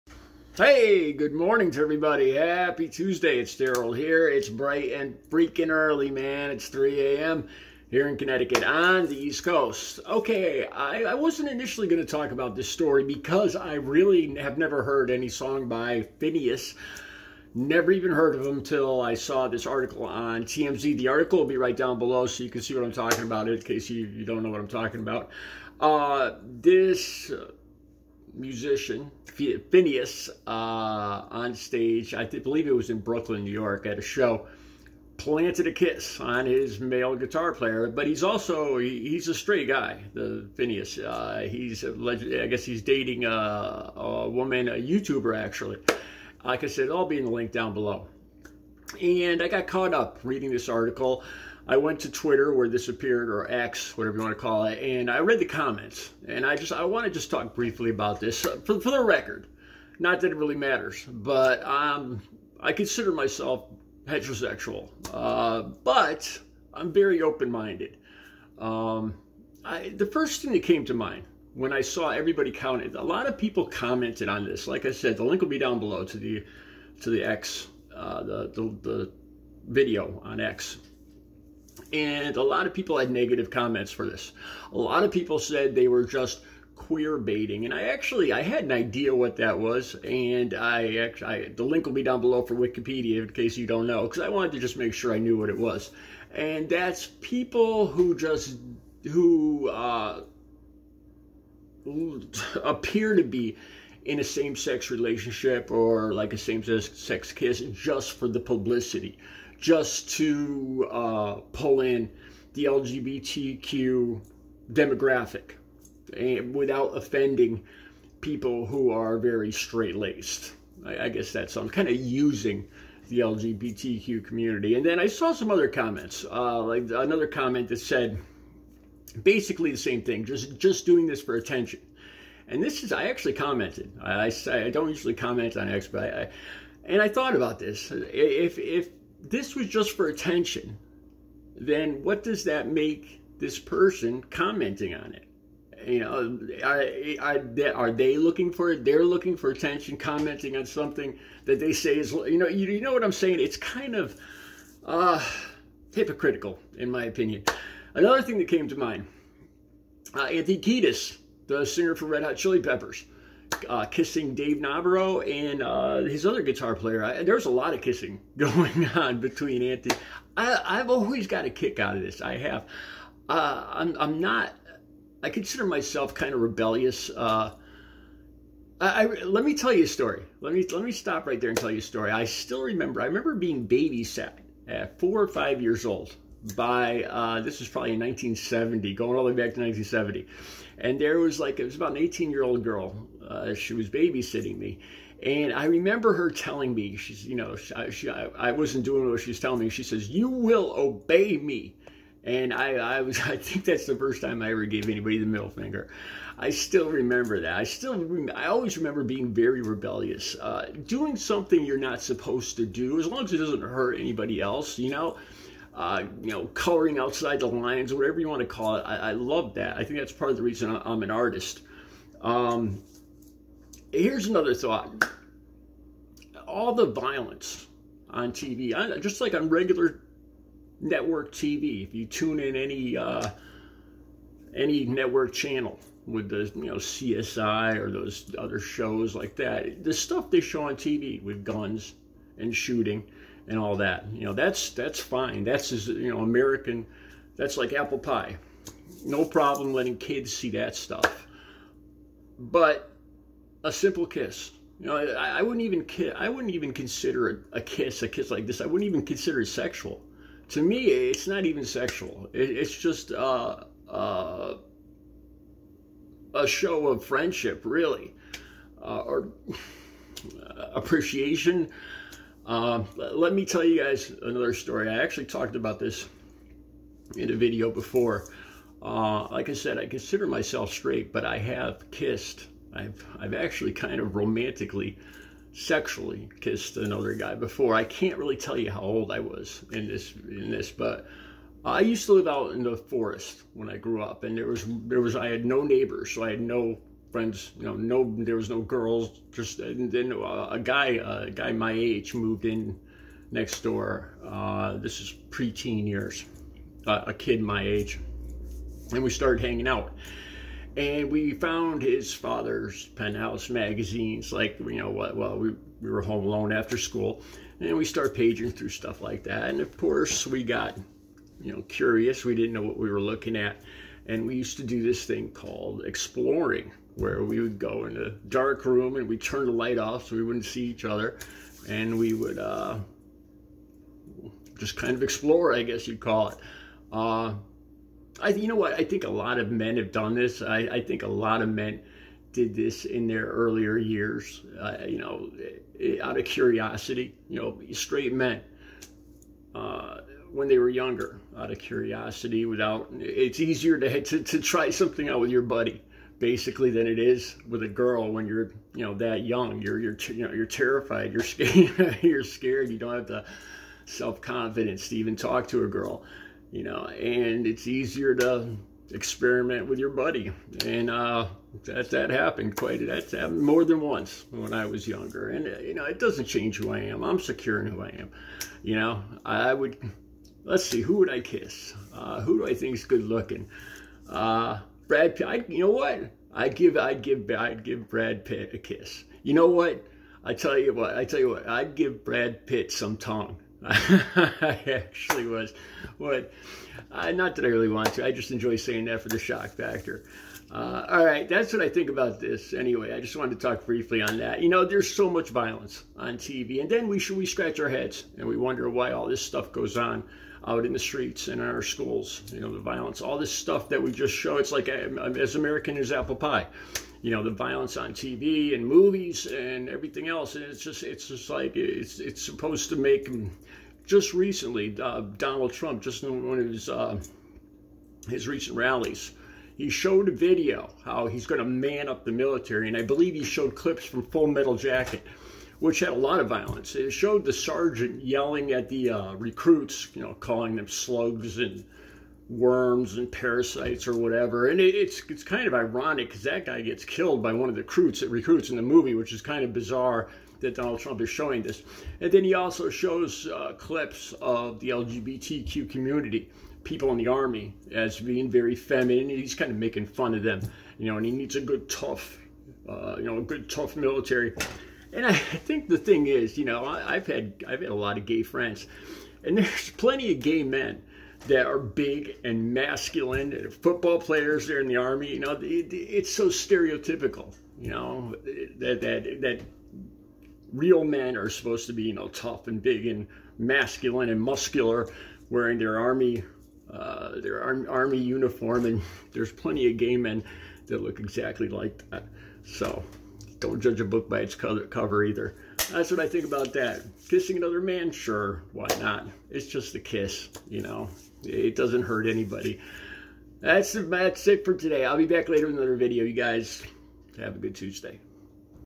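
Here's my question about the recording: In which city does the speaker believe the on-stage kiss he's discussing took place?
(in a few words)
Brooklyn.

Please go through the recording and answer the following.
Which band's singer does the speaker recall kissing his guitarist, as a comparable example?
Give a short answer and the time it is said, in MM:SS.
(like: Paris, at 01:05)
Red Hot Chili Peppers, at 02:42.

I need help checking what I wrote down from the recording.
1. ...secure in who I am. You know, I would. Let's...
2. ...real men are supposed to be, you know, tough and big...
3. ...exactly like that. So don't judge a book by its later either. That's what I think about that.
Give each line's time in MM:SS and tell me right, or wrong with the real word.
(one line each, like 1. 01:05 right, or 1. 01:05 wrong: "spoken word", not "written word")
1. 06:17 right
2. 08:00 right
3. 08:10 wrong: "cover", not "later".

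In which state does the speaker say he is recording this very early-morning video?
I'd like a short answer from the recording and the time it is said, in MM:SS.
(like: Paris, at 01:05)
Connecticut, at 00:08.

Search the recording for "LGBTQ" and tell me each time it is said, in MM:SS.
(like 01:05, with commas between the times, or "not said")
01:52, 02:03, 07:34.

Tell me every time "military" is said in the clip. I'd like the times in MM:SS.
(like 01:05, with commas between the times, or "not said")
07:12, 07:43.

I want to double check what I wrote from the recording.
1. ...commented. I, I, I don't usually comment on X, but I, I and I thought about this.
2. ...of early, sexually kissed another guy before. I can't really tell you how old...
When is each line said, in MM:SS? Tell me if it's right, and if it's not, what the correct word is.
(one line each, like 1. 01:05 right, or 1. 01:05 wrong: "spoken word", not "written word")
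1. 02:13 right
2. 04:43 wrong: "romantically", not "early".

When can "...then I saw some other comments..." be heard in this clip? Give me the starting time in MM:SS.
02:04.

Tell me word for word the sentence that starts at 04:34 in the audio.
I actually talked about this in a video before.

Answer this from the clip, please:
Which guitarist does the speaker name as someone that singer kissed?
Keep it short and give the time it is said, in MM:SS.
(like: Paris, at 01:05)
Dave Navarro, at 02:44.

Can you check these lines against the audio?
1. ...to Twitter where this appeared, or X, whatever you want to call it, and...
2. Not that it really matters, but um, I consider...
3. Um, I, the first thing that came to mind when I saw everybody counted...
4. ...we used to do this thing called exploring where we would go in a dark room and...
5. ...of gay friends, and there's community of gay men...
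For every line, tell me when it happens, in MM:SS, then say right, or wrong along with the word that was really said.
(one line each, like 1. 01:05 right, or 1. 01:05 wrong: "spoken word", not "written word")
1. 00:52 right
2. 00:59 right
3. 01:08 right
4. 05:24 right
5. 07:47 wrong: "plenty", not "community".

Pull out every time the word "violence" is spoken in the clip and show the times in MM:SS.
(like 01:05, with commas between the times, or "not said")
03:46, 06:45, 06:52, 06:57, 07:16.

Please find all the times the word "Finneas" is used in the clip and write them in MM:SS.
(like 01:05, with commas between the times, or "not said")
00:16, 00:29, 00:40.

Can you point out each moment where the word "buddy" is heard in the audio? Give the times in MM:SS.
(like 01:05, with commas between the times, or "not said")
05:55, 06:09.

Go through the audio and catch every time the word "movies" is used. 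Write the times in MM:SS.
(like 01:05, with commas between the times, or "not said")
06:58, 07:28.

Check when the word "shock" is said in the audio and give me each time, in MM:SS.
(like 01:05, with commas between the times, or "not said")
06:39.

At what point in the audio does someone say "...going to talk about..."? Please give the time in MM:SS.
00:11.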